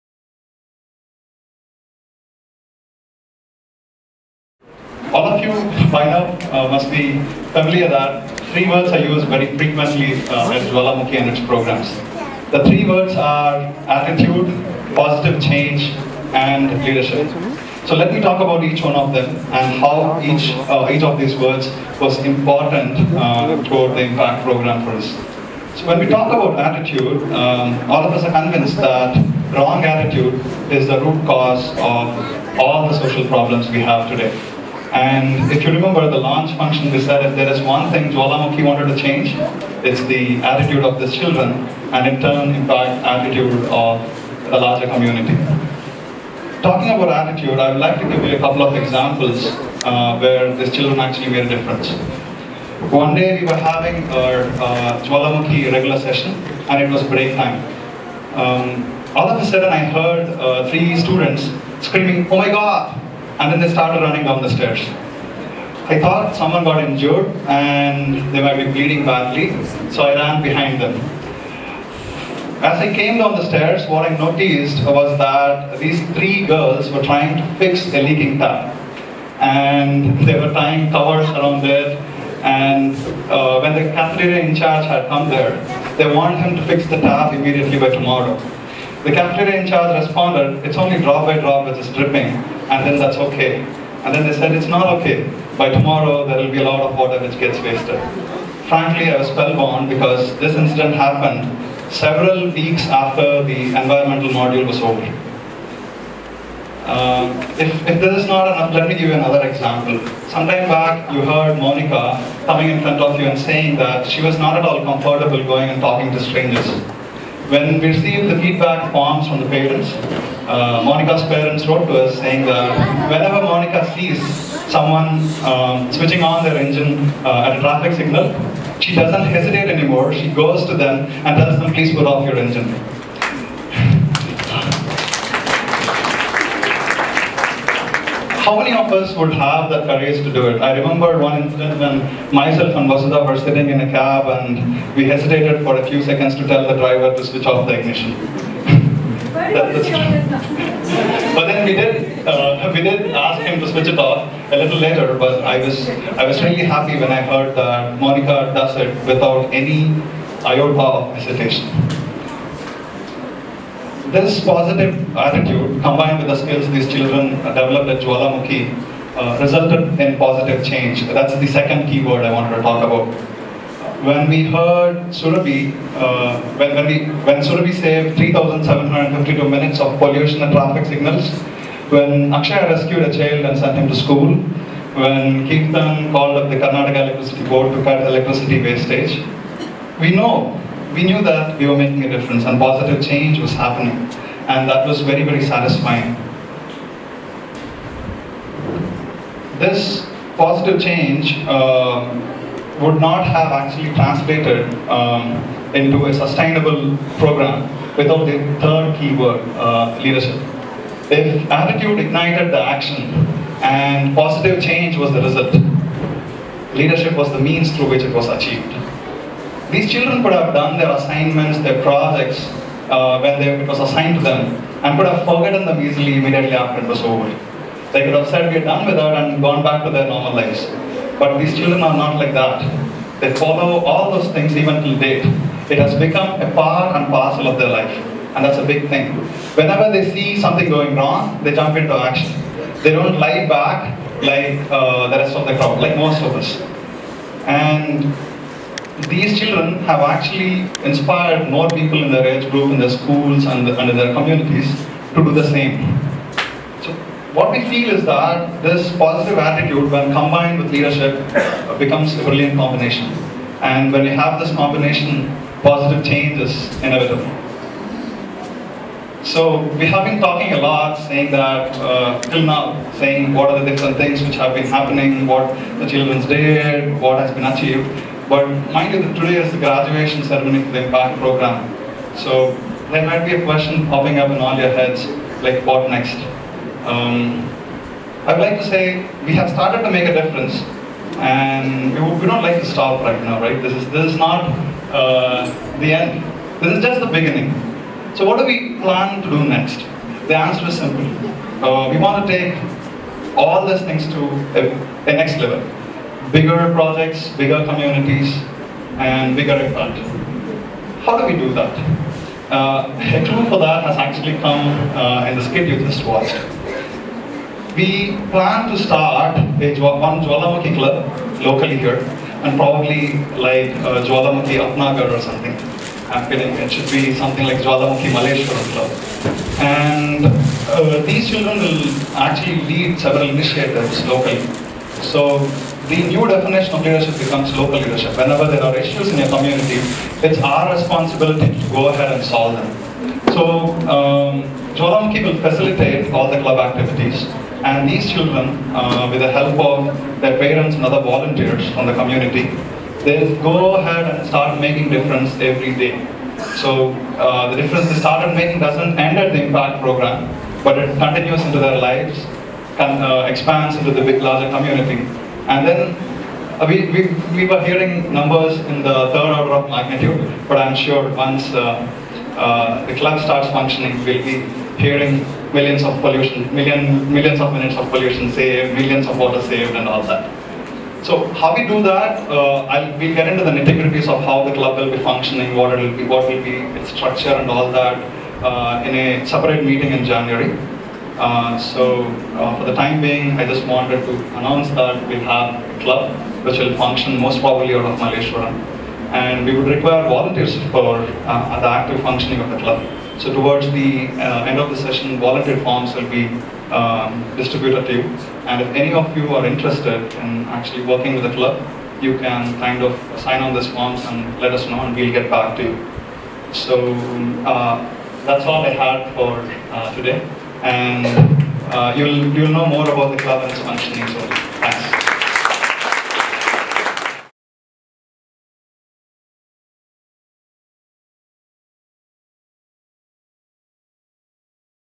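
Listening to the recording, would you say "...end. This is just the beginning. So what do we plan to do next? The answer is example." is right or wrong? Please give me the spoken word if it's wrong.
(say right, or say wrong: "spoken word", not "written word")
wrong: "simple", not "example".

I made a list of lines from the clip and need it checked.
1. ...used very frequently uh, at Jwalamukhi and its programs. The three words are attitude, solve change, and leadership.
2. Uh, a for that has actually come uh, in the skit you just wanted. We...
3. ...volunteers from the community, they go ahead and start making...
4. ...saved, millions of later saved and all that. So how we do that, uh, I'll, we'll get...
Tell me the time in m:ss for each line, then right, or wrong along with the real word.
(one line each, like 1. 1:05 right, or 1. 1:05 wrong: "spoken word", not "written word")
1. 0:08 wrong: "positive", not "solve"
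2. 5:12 wrong: "watched", not "wanted"
3. 5:51 right
4. 6:18 wrong: "water", not "later".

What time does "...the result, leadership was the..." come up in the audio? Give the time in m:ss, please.
3:35.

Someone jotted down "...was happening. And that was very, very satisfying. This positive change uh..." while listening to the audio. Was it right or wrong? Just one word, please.
right.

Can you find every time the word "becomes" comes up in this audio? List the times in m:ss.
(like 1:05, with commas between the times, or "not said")
3:55, 4:21, 5:37.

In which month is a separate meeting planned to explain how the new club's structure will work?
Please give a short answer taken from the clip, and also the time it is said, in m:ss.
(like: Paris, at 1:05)
January, at 6:30.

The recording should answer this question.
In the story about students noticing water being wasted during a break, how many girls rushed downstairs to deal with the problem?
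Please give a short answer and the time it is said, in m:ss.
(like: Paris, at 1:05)
3, at 1:16.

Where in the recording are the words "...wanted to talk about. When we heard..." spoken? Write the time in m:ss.
2:52.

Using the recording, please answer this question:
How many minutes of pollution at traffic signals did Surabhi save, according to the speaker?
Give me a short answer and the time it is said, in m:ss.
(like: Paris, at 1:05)
3,752, at 2:58.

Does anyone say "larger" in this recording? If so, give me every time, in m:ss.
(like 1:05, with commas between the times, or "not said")
0:44, 6:04.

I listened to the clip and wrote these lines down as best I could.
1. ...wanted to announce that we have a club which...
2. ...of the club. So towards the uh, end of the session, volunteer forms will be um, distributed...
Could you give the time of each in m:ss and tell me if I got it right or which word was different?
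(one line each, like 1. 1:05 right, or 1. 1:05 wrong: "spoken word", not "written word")
1. 6:33 right
2. 6:42 right.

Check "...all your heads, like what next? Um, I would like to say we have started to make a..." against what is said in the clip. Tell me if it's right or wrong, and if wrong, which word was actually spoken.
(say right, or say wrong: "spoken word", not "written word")
right.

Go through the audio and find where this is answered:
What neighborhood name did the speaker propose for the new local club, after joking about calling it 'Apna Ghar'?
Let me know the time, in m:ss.
5:28.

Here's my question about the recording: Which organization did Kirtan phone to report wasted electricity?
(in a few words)
Karnataka Electricity Board.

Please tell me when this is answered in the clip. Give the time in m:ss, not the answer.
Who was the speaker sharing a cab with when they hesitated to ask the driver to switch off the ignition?
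2:22.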